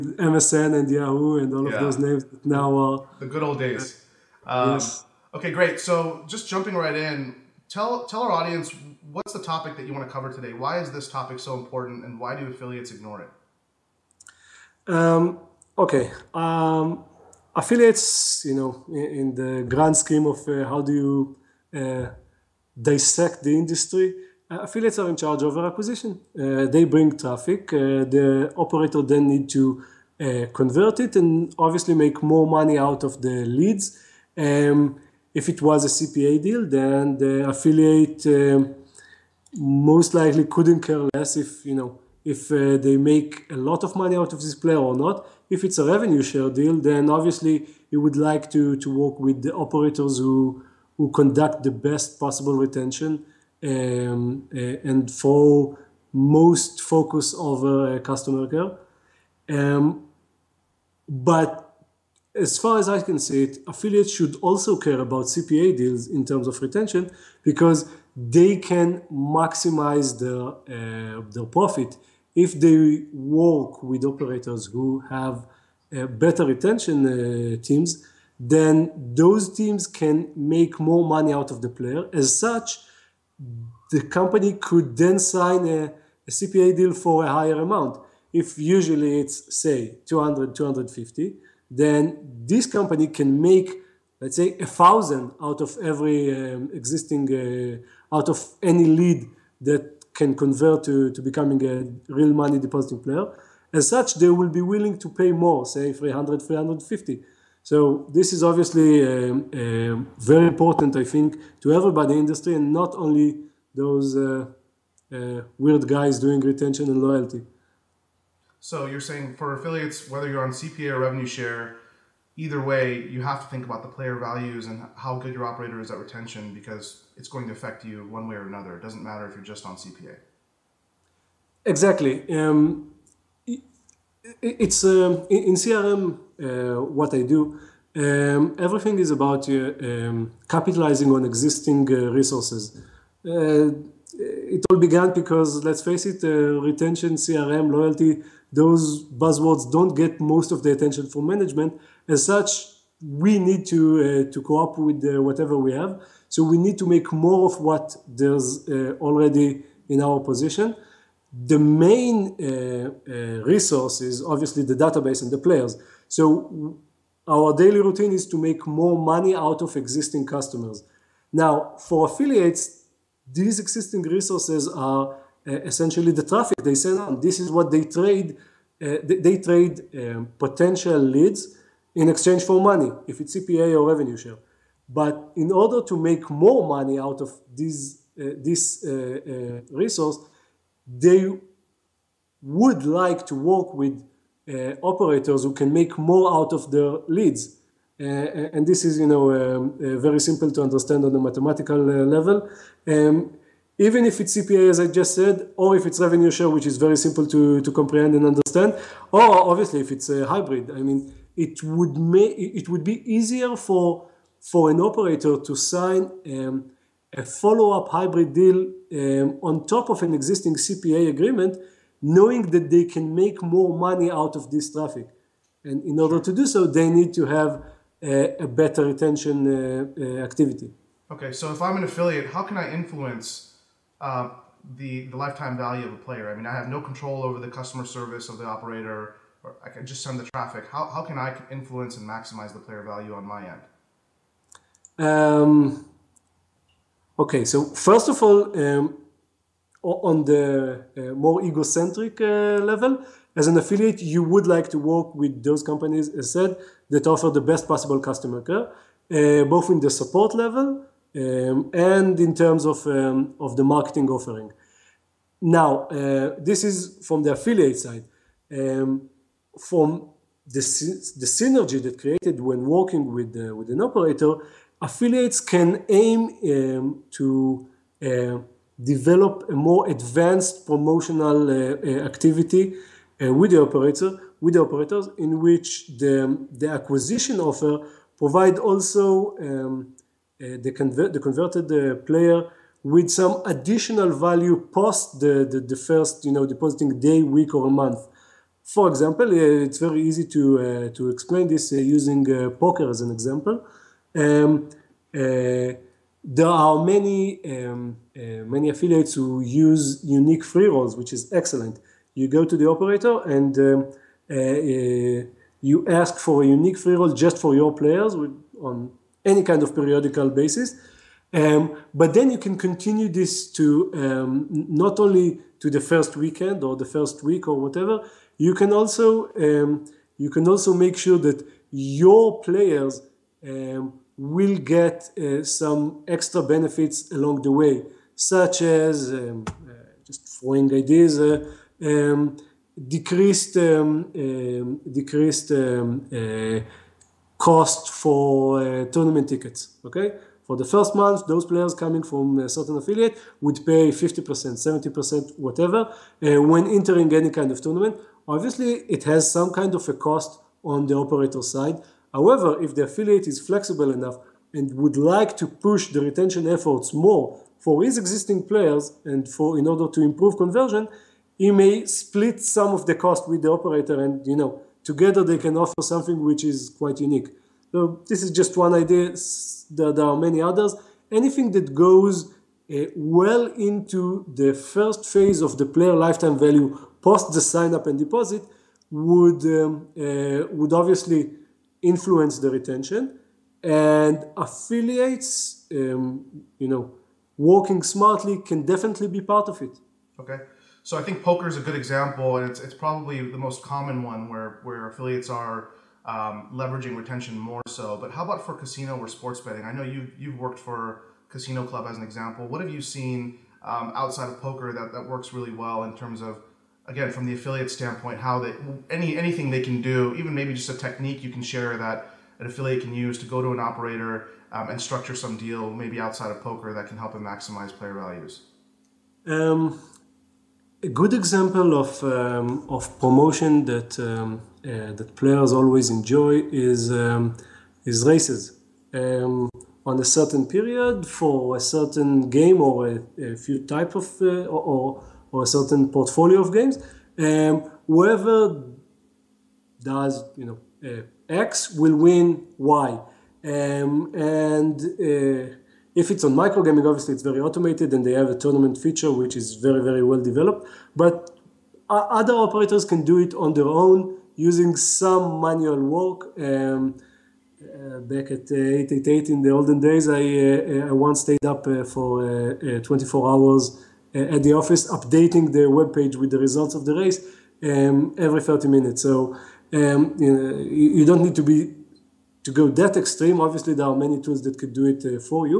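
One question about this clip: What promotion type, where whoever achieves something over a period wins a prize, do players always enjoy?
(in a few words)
races.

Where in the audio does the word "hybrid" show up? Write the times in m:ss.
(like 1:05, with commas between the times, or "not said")
3:30, 3:37.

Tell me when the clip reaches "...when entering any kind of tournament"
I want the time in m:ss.
5:56.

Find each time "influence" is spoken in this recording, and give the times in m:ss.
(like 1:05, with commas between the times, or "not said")
3:52, 4:01, 6:31.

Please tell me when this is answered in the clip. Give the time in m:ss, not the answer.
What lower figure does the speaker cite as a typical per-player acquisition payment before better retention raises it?
1:30.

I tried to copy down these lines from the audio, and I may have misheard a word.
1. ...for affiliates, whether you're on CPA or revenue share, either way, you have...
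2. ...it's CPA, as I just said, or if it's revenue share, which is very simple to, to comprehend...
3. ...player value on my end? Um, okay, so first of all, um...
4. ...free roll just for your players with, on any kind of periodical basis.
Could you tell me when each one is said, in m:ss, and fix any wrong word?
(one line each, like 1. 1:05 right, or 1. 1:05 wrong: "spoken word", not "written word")
1. 1:59 right
2. 3:24 right
3. 4:02 right
4. 5:16 right.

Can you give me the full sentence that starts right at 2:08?
It doesn't matter if you're just on CPA.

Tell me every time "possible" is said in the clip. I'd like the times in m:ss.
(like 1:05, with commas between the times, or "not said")
0:52, 4:17.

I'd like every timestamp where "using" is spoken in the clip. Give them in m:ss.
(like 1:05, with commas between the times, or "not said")
5:01, 7:44.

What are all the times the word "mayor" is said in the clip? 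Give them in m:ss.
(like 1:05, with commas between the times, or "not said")
not said.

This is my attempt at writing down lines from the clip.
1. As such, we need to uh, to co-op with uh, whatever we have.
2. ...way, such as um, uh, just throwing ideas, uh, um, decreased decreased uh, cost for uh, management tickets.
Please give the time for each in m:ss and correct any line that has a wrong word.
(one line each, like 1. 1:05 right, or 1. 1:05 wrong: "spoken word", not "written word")
1. 2:32 right
2. 5:37 wrong: "tournament", not "management".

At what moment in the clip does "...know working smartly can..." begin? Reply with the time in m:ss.
6:36.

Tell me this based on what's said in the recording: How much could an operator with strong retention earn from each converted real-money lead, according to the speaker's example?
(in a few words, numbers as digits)
1000.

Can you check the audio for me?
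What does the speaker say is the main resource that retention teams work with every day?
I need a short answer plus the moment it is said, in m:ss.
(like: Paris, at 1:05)
the database, at 2:44.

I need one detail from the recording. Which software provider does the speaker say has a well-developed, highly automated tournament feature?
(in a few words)
Microgaming.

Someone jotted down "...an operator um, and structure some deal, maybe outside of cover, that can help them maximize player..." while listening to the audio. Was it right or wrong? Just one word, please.
wrong.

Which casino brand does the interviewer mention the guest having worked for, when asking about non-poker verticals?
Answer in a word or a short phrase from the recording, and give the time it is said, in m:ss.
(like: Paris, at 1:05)
Casino Club, at 6:51.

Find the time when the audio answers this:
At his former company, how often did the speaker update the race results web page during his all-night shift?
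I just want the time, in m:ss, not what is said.
7:58.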